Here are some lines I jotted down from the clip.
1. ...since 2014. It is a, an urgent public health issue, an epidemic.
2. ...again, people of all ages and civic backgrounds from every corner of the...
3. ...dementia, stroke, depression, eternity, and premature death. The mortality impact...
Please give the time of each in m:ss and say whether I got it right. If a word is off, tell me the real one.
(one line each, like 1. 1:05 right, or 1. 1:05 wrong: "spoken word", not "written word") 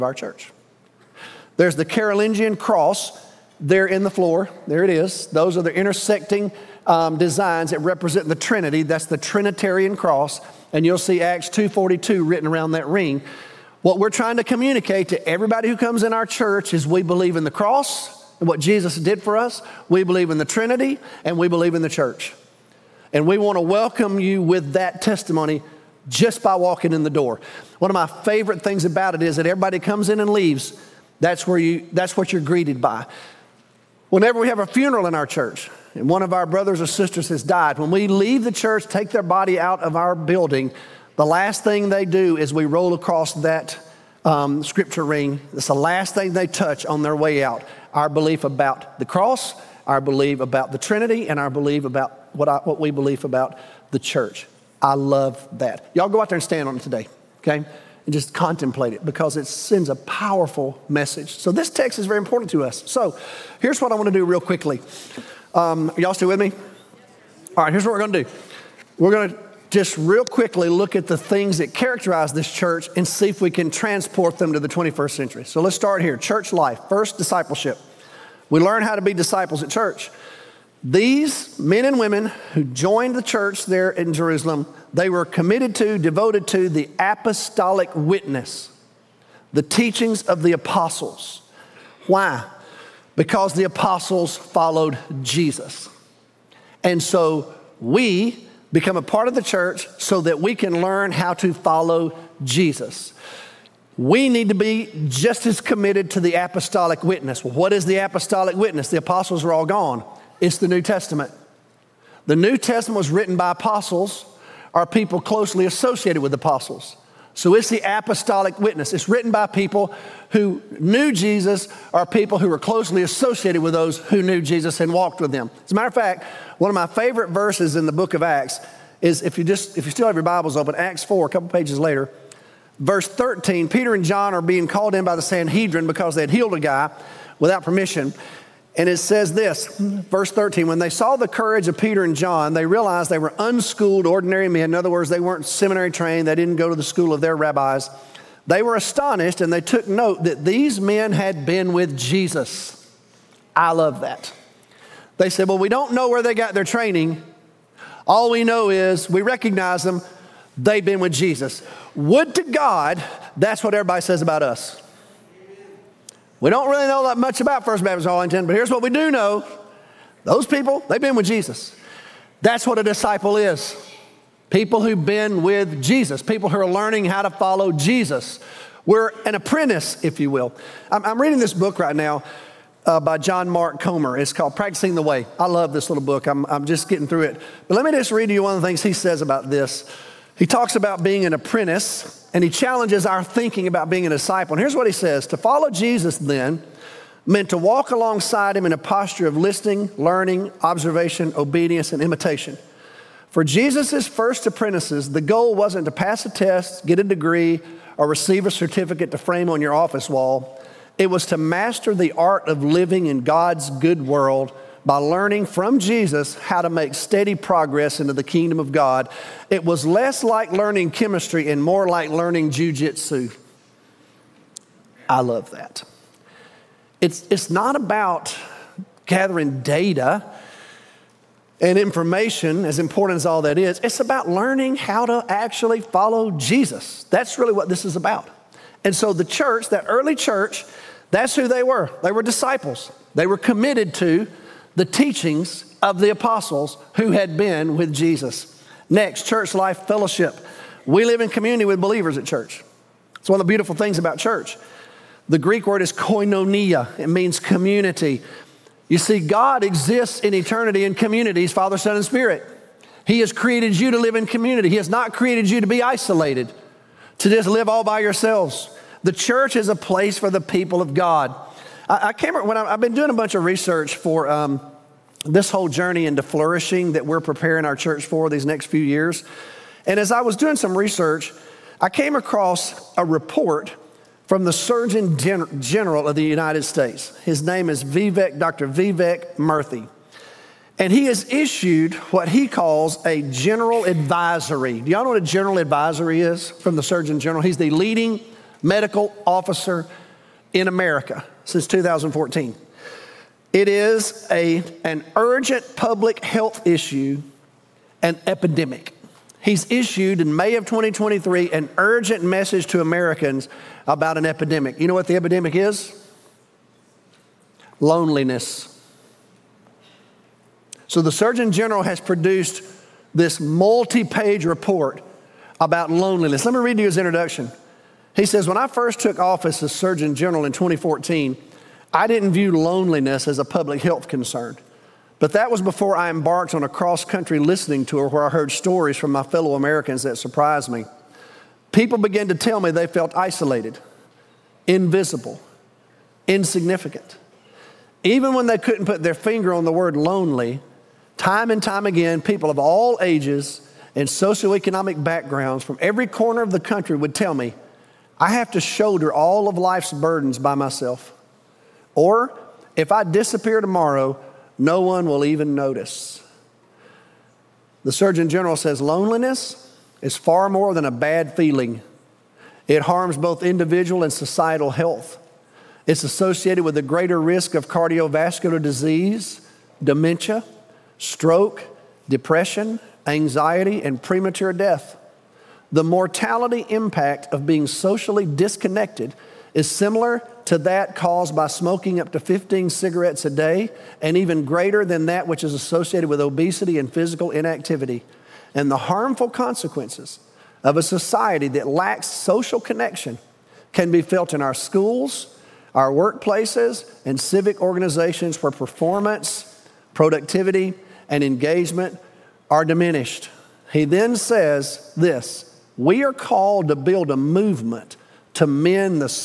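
1. 5:01 right
2. 5:51 wrong: "socioeconomic", not "civic"
3. 6:19 wrong: "anxiety", not "eternity".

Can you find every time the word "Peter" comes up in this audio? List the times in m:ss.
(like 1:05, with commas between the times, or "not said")
2:13, 2:21.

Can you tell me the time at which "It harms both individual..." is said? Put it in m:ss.
6:12.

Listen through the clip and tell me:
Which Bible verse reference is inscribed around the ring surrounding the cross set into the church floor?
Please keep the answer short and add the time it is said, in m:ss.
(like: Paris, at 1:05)
Acts 2:42, at 0:11.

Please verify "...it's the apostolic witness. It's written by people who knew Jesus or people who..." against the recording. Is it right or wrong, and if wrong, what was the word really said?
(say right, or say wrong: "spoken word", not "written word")
right.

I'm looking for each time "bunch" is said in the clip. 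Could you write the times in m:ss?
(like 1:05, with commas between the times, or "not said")
4:33.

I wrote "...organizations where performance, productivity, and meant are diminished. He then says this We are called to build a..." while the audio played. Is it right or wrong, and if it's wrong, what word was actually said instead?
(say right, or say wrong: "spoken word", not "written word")
wrong: "engagement", not "meant".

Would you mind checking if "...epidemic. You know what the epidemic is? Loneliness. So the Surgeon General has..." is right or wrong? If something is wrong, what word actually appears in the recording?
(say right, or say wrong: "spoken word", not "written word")
right.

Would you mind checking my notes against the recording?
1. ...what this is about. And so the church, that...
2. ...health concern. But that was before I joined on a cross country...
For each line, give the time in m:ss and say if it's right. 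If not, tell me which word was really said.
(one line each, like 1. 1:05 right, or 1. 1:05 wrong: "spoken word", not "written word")
1. 3:57 right
2. 5:33 wrong: "embarked", not "joined".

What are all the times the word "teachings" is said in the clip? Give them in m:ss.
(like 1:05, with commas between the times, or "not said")
1:29, 4:04.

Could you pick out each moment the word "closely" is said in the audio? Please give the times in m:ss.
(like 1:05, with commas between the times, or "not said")
1:55, 2:02.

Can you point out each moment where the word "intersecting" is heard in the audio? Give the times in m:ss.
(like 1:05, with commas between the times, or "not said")
0:05.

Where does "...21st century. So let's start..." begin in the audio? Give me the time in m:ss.
1:14.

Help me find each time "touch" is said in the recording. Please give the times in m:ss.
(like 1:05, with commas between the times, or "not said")
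0:46.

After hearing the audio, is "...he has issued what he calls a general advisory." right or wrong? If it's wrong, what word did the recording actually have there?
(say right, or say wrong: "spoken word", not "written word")
right.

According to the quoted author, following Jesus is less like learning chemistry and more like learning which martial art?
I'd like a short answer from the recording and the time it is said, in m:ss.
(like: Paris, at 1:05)
jujitsu, at 3:42.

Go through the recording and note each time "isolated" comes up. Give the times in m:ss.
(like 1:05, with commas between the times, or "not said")
4:25, 5:43.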